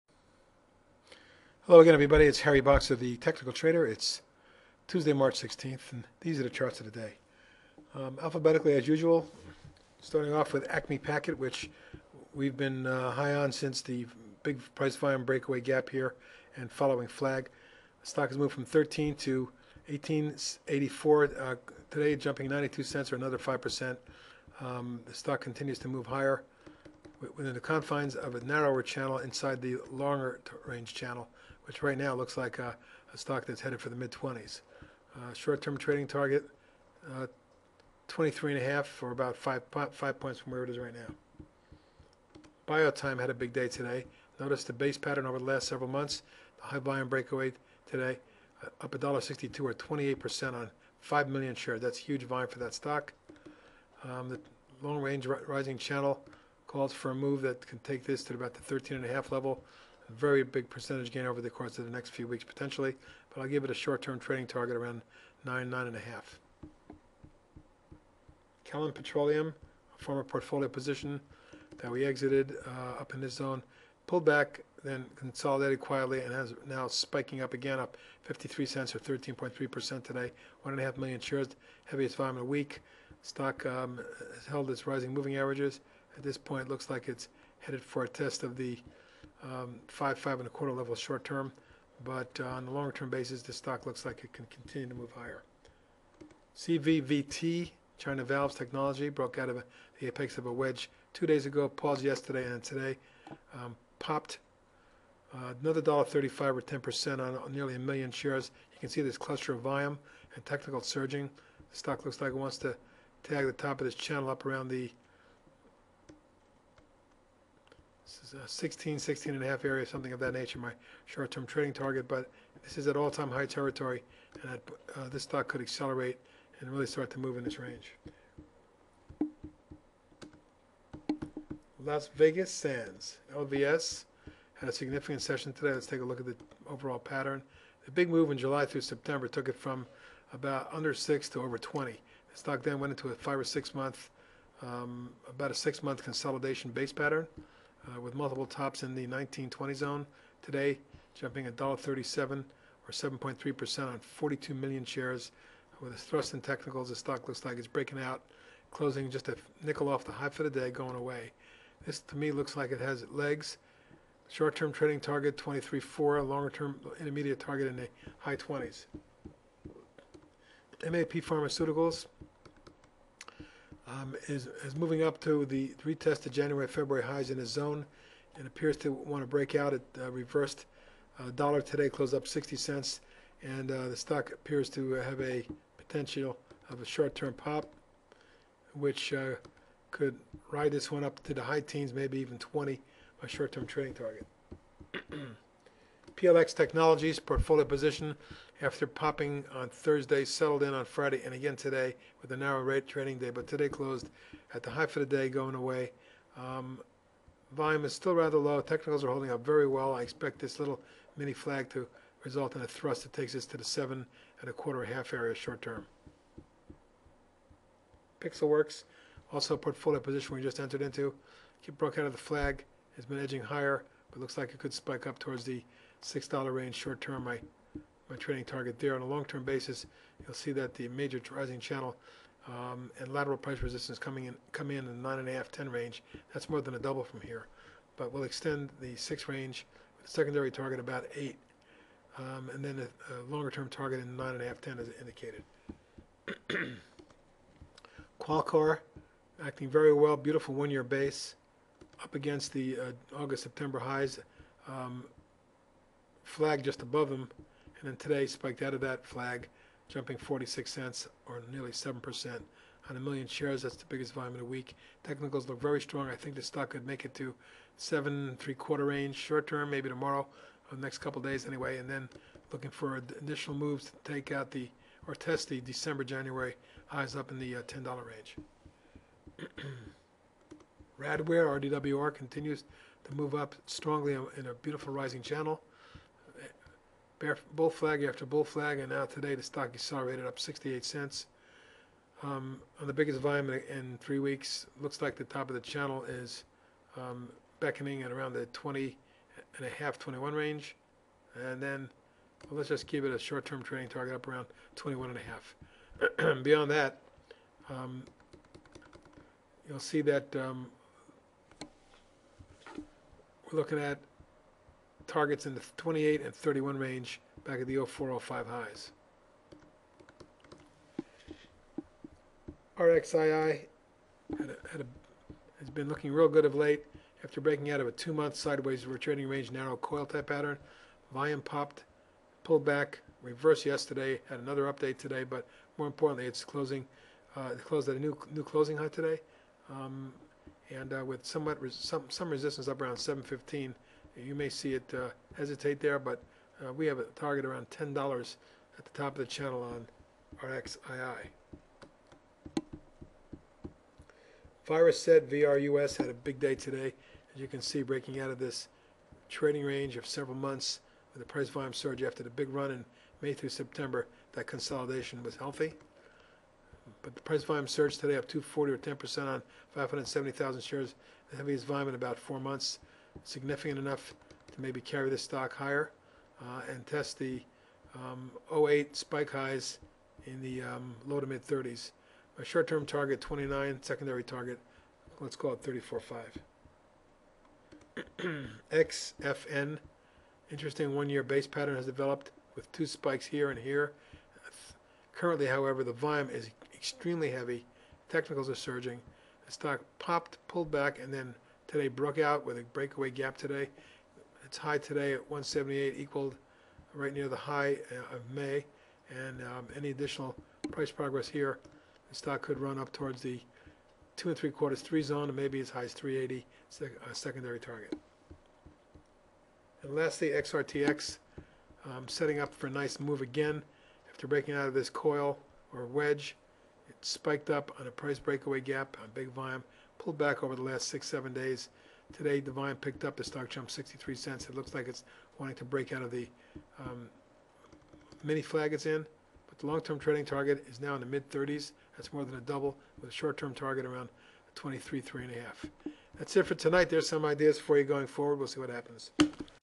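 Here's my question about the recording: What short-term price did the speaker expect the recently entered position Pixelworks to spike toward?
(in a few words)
$6.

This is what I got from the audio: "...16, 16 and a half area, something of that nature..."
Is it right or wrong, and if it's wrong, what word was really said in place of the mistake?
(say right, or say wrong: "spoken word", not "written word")
right.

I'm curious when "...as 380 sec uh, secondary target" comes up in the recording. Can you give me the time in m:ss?
6:55.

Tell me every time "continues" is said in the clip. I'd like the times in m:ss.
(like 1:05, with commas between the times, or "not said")
0:25, 1:34, 4:42.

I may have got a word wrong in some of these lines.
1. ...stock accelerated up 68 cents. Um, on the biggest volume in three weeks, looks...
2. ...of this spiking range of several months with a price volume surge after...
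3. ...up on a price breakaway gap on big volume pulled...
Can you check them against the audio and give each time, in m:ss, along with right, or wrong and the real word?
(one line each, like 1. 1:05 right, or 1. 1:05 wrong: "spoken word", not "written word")
1. 4:49 right
2. 5:58 wrong: "trading", not "spiking"
3. 7:07 right.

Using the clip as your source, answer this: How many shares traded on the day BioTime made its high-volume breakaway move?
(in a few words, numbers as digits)
5 million.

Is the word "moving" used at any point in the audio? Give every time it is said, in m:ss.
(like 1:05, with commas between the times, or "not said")
1:25, 2:54.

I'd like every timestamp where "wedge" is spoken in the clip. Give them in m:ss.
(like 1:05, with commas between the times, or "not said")
1:40, 7:05.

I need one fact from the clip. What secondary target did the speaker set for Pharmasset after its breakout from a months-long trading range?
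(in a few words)
34.5.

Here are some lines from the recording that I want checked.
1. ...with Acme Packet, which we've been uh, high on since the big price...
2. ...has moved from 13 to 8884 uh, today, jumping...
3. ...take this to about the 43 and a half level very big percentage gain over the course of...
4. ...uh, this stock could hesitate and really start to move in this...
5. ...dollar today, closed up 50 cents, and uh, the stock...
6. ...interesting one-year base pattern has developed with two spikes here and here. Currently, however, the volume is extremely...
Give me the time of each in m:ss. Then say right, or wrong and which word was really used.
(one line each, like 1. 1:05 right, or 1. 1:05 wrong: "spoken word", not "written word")
1. 0:10 right
2. 0:18 wrong: "1884", not "8884"
3. 0:57 wrong: "13", not "43"
4. 2:04 wrong: "accelerate", not "hesitate"
5. 3:01 wrong: "60", not "50"
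6. 6:30 right.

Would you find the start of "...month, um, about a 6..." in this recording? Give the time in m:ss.
2:23.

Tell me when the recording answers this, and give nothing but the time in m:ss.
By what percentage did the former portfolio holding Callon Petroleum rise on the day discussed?
1:18.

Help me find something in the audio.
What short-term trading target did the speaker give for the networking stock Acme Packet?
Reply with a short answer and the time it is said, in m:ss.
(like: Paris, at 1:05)
23.5, at 0:38.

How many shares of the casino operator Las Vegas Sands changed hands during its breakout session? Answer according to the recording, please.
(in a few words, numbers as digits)
42 million.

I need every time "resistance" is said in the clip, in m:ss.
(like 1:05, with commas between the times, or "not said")
3:53, 5:42.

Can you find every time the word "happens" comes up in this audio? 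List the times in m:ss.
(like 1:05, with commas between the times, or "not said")
7:28.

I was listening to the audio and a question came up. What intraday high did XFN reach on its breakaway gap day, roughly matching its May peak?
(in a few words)
1.78.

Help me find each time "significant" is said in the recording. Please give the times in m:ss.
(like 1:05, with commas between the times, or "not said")
2:14, 6:13.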